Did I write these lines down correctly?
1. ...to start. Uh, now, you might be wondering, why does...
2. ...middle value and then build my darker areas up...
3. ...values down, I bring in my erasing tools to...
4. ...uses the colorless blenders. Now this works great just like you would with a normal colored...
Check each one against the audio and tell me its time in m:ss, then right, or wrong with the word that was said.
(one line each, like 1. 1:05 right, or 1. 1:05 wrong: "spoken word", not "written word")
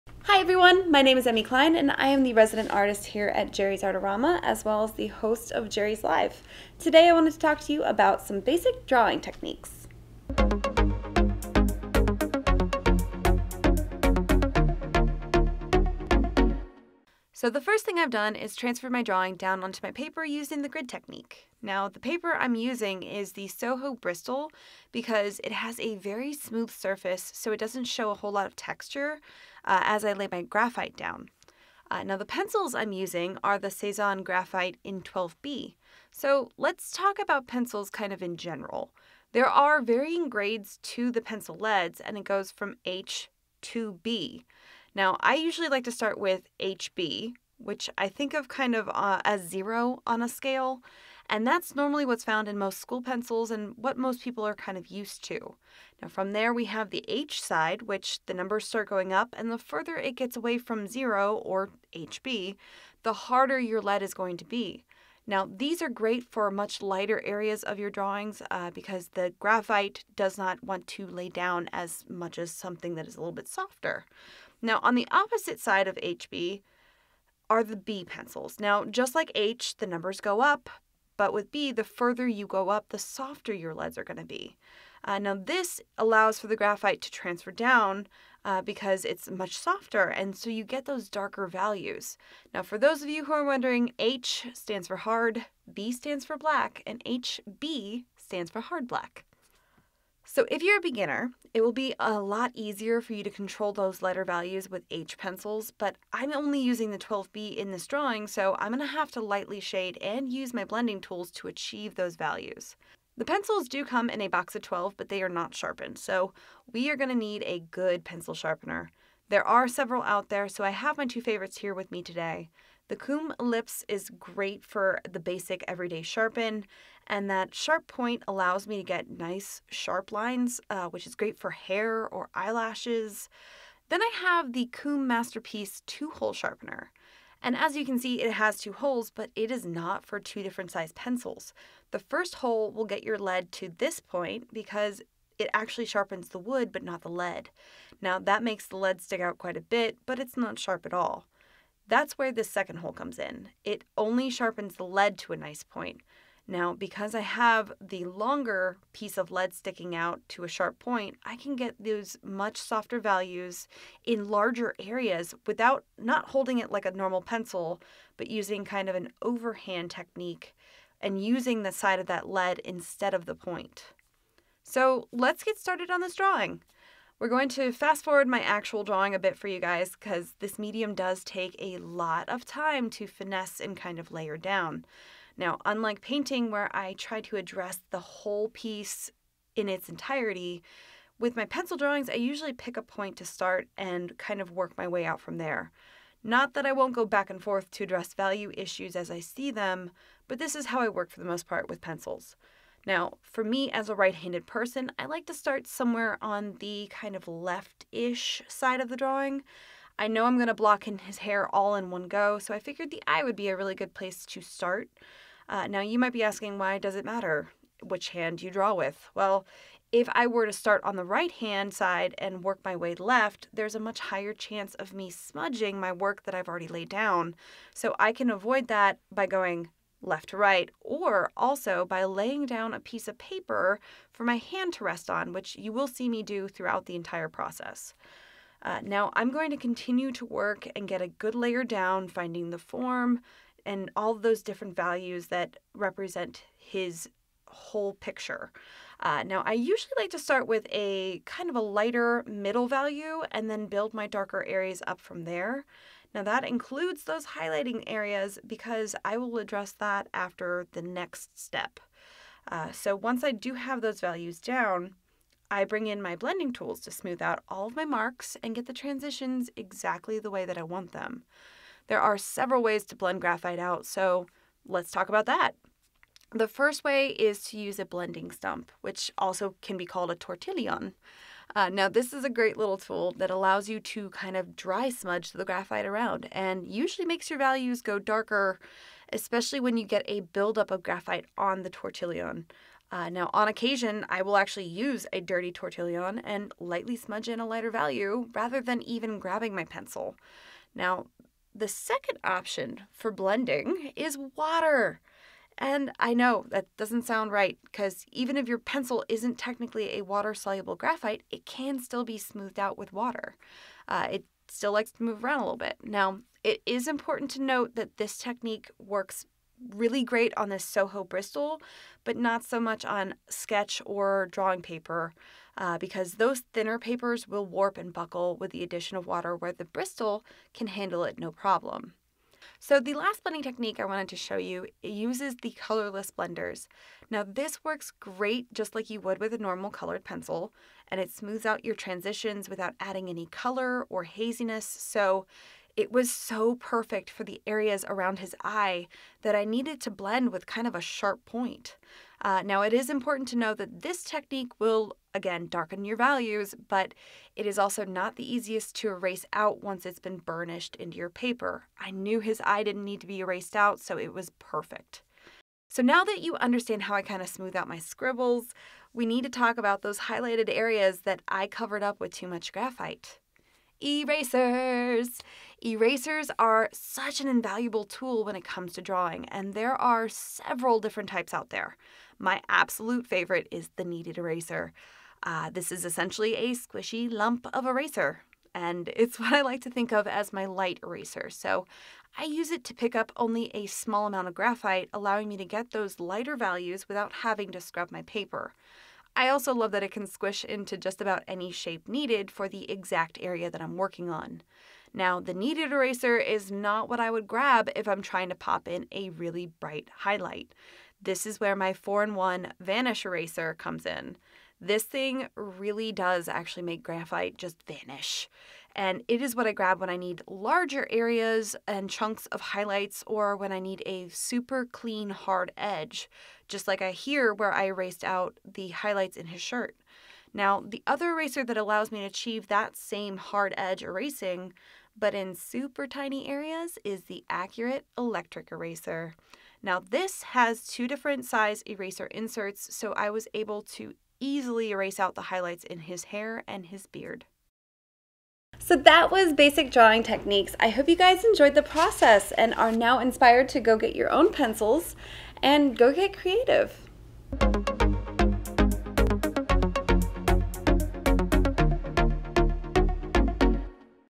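1. 3:34 wrong: "asking", not "wondering"
2. 4:12 right
3. 4:24 wrong: "blending", not "erasing"
4. 5:34 right.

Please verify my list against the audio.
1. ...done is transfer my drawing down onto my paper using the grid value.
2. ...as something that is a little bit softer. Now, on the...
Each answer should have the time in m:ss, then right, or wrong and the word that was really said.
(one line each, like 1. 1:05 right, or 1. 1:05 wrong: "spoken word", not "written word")
1. 0:18 wrong: "technique", not "value"
2. 1:12 right.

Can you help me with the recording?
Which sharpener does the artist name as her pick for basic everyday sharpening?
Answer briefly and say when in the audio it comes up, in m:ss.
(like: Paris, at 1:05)
KUM Lips, at 2:02.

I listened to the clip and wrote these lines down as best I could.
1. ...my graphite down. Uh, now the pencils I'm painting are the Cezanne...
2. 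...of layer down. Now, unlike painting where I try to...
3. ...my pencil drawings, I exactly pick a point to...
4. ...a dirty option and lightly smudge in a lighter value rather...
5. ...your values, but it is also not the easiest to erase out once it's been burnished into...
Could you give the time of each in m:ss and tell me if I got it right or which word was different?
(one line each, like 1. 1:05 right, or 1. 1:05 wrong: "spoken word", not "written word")
1. 0:30 wrong: "using", not "painting"
2. 3:03 right
3. 3:11 wrong: "usually", not "exactly"
4. 4:55 wrong: "tortillon", not "option"
5. 5:55 right.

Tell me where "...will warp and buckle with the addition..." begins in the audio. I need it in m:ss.
5:27.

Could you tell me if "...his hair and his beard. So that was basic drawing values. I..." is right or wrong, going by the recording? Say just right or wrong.
wrong.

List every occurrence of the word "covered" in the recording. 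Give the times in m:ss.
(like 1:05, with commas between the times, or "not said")
6:11.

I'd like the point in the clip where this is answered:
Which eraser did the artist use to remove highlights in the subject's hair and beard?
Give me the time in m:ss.
7:17.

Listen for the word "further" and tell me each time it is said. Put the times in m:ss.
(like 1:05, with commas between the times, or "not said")
0:59, 1:21.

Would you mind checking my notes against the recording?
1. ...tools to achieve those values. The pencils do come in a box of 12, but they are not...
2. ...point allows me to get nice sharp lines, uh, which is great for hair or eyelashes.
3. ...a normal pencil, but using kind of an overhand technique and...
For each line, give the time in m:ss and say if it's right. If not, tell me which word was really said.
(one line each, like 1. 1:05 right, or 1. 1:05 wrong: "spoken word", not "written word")
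1. 1:51 right
2. 2:07 right
3. 2:46 right.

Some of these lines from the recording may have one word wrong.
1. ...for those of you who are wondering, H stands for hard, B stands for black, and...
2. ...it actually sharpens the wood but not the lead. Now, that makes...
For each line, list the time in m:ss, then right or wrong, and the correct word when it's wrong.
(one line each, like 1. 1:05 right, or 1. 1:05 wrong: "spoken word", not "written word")
1. 1:32 right
2. 2:25 right.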